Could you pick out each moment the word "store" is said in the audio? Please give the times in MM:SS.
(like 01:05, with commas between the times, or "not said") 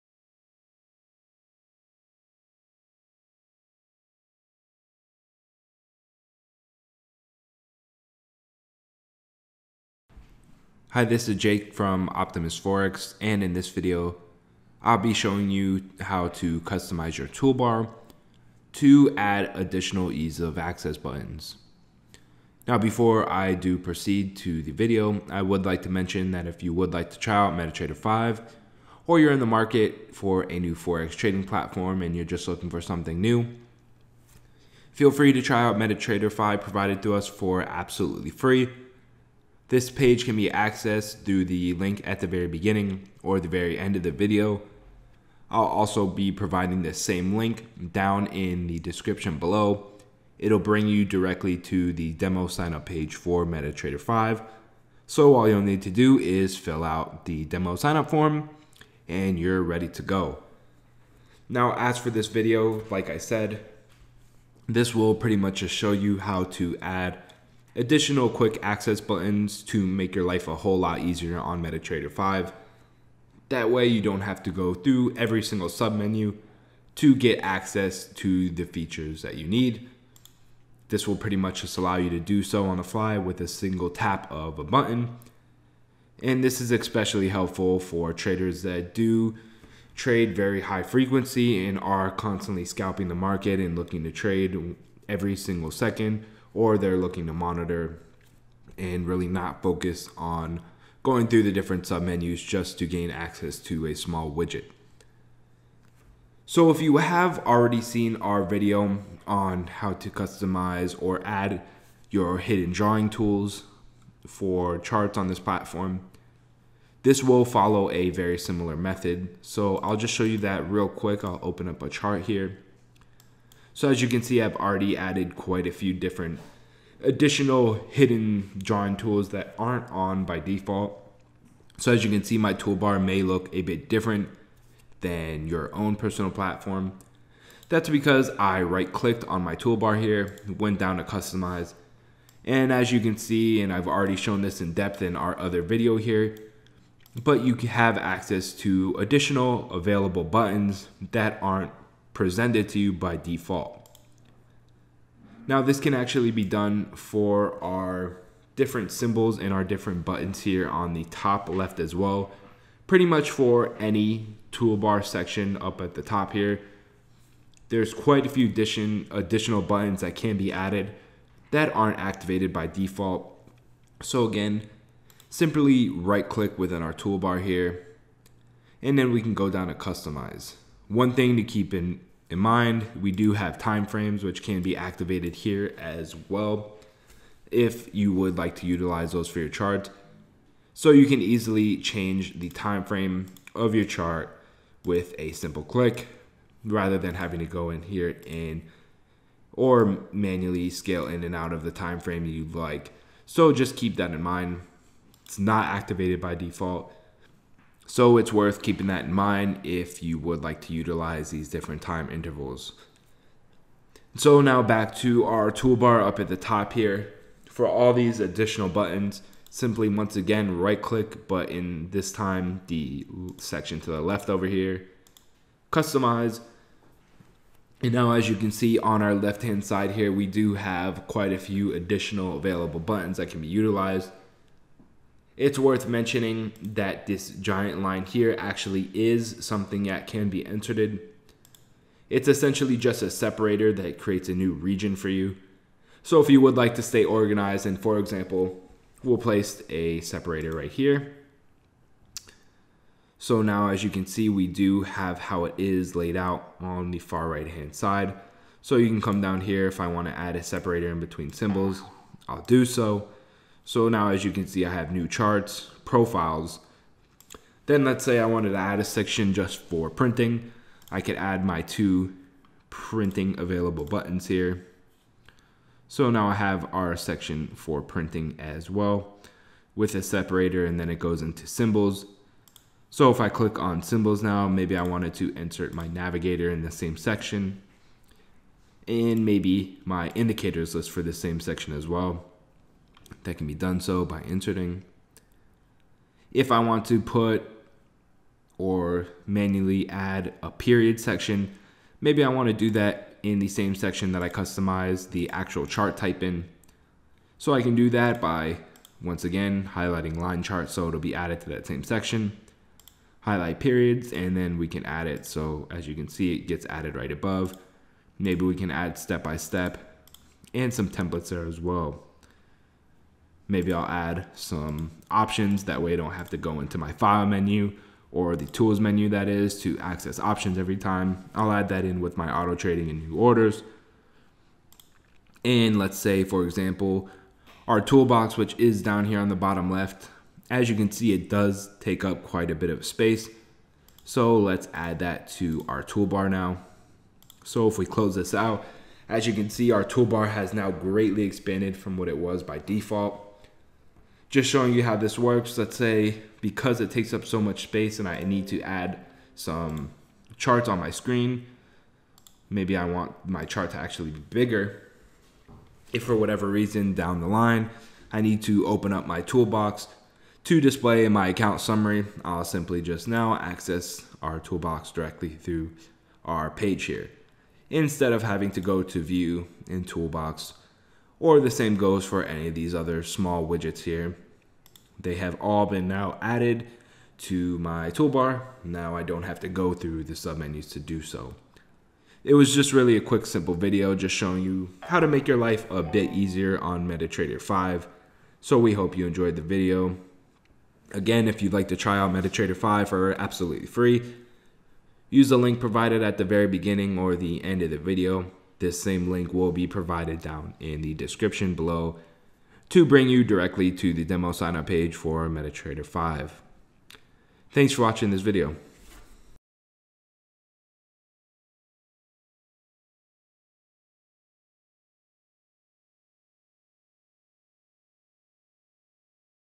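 not said.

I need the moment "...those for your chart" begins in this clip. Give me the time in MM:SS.
03:09.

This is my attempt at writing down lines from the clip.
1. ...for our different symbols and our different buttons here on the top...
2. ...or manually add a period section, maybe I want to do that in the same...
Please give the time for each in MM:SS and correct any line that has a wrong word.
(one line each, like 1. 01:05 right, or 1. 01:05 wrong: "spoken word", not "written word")
1. 02:36 right
2. 04:58 right.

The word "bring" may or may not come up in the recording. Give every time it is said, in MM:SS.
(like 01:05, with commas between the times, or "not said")
00:50, 06:52.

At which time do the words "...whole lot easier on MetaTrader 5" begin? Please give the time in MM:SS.
01:10.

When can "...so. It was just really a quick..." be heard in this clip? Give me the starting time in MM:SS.
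06:31.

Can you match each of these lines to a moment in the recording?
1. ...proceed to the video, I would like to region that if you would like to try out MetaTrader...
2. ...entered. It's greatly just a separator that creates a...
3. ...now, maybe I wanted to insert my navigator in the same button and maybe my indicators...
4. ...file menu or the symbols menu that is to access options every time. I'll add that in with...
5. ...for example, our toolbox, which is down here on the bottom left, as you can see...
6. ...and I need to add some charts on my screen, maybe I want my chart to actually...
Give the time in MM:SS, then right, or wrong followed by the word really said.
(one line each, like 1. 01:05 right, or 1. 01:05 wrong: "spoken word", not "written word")
1. 00:23 wrong: "mention", not "region"
2. 04:00 wrong: "essentially", not "greatly"
3. 04:44 wrong: "section", not "button"
4. 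05:26 wrong: "tools", not "symbols"
5. 05:36 right
6. 05:57 right.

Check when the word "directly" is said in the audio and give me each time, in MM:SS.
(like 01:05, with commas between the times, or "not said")
00:51, 06:14, 06:53.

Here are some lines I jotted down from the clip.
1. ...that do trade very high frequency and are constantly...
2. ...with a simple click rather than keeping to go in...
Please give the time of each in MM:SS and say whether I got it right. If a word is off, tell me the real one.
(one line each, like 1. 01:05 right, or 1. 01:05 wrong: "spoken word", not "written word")
1. 01:28 right
2. 03:14 wrong: "having", not "keeping".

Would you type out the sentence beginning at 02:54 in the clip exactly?
So again, simply right click within our toolbar here, and then we can go down to customize.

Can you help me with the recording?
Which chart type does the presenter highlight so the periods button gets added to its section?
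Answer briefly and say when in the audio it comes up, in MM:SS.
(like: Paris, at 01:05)
line chart, at 05:10.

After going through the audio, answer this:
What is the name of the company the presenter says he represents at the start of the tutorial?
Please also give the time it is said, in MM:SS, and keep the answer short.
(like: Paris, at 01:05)
Optimus Forex, at 00:12.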